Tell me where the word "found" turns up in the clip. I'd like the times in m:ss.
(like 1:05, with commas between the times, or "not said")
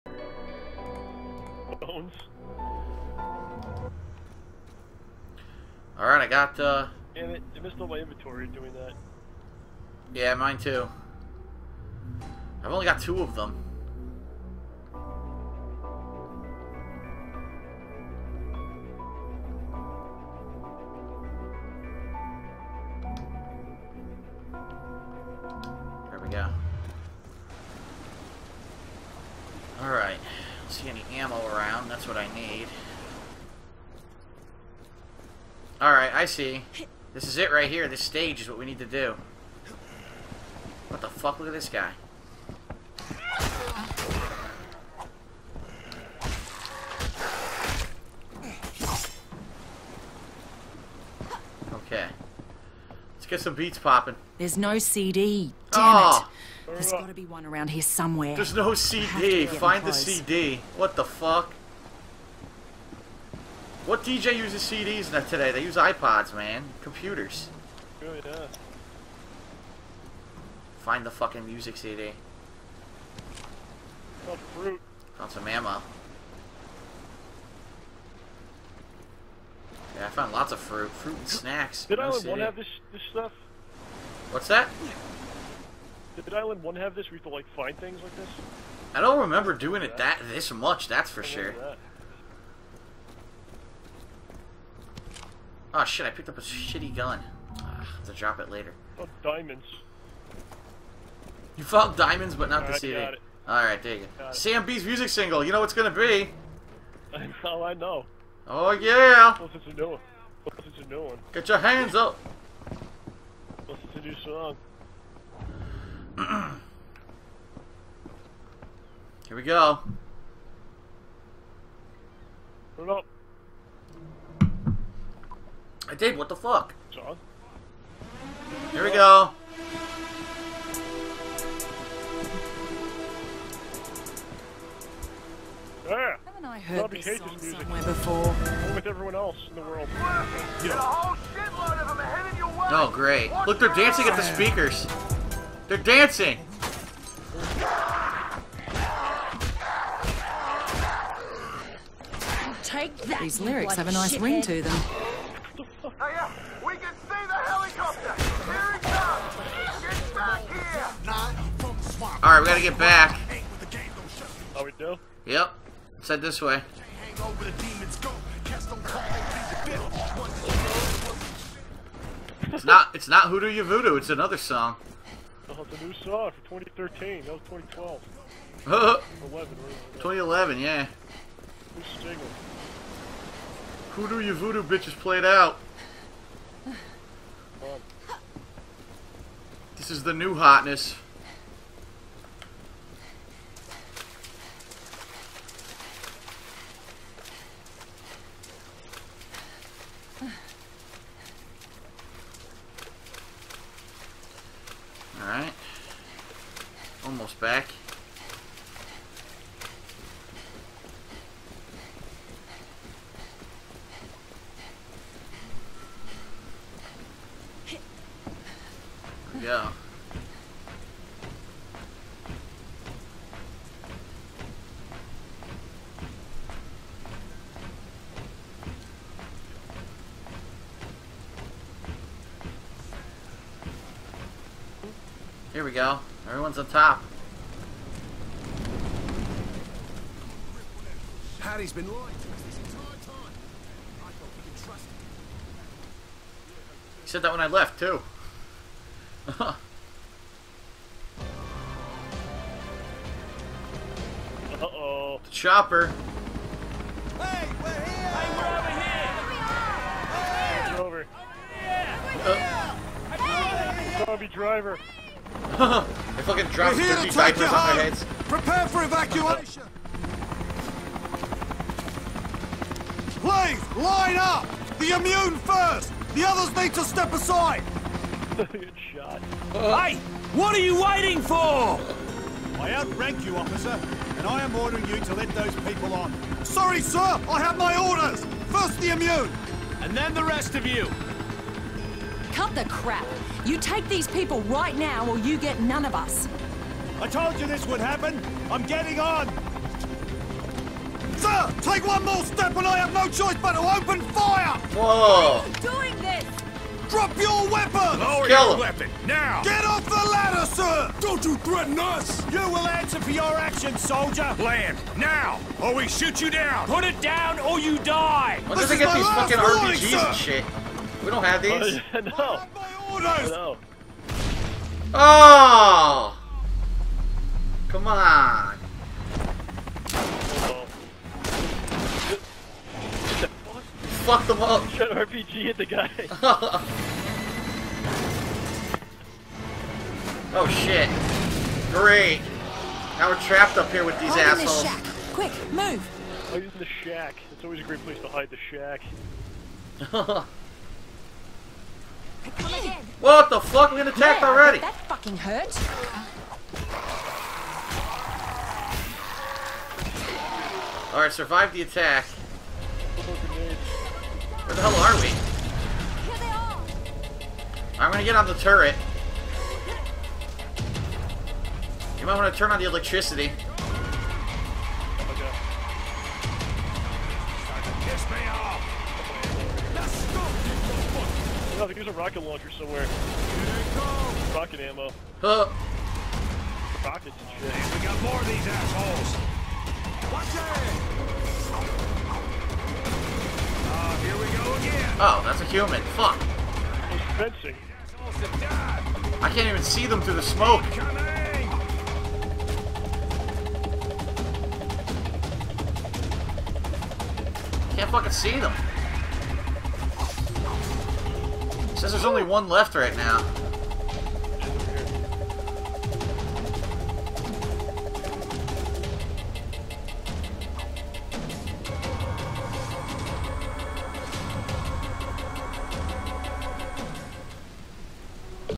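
1:15, 1:20, 1:41.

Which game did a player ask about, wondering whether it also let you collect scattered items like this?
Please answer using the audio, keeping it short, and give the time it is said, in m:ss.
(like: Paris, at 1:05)
Dead Island 1, at 1:26.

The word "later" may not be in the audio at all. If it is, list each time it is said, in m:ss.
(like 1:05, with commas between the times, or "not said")
1:38.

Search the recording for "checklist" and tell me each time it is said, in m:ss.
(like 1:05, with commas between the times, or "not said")
not said.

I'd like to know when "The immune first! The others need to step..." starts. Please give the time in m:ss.
4:34.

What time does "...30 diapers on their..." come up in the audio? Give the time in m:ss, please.
4:26.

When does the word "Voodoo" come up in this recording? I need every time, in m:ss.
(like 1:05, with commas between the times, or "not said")
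2:53, 3:04.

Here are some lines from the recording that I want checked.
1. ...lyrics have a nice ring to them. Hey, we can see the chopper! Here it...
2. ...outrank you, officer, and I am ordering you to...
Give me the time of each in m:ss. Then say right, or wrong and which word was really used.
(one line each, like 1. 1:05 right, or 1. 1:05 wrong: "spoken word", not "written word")
1. 2:33 wrong: "helicopter", not "chopper"
2. 4:42 right.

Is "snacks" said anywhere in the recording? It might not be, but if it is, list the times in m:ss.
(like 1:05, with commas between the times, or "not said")
1:21.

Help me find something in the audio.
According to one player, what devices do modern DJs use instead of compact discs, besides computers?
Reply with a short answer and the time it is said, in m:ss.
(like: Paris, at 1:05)
iPods, at 1:05.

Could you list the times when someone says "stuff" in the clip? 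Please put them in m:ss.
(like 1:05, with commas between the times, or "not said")
1:23.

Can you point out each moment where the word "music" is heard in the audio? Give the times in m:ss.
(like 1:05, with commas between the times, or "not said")
1:11, 1:44.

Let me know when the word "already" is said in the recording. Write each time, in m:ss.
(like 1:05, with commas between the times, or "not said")
5:54.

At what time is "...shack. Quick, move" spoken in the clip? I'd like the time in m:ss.
5:44.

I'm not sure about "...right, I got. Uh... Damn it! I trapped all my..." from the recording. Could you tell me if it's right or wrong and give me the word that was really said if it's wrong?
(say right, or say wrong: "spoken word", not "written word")
wrong: "missed", not "trapped".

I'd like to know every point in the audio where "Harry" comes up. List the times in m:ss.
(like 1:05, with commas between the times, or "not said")
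4:01.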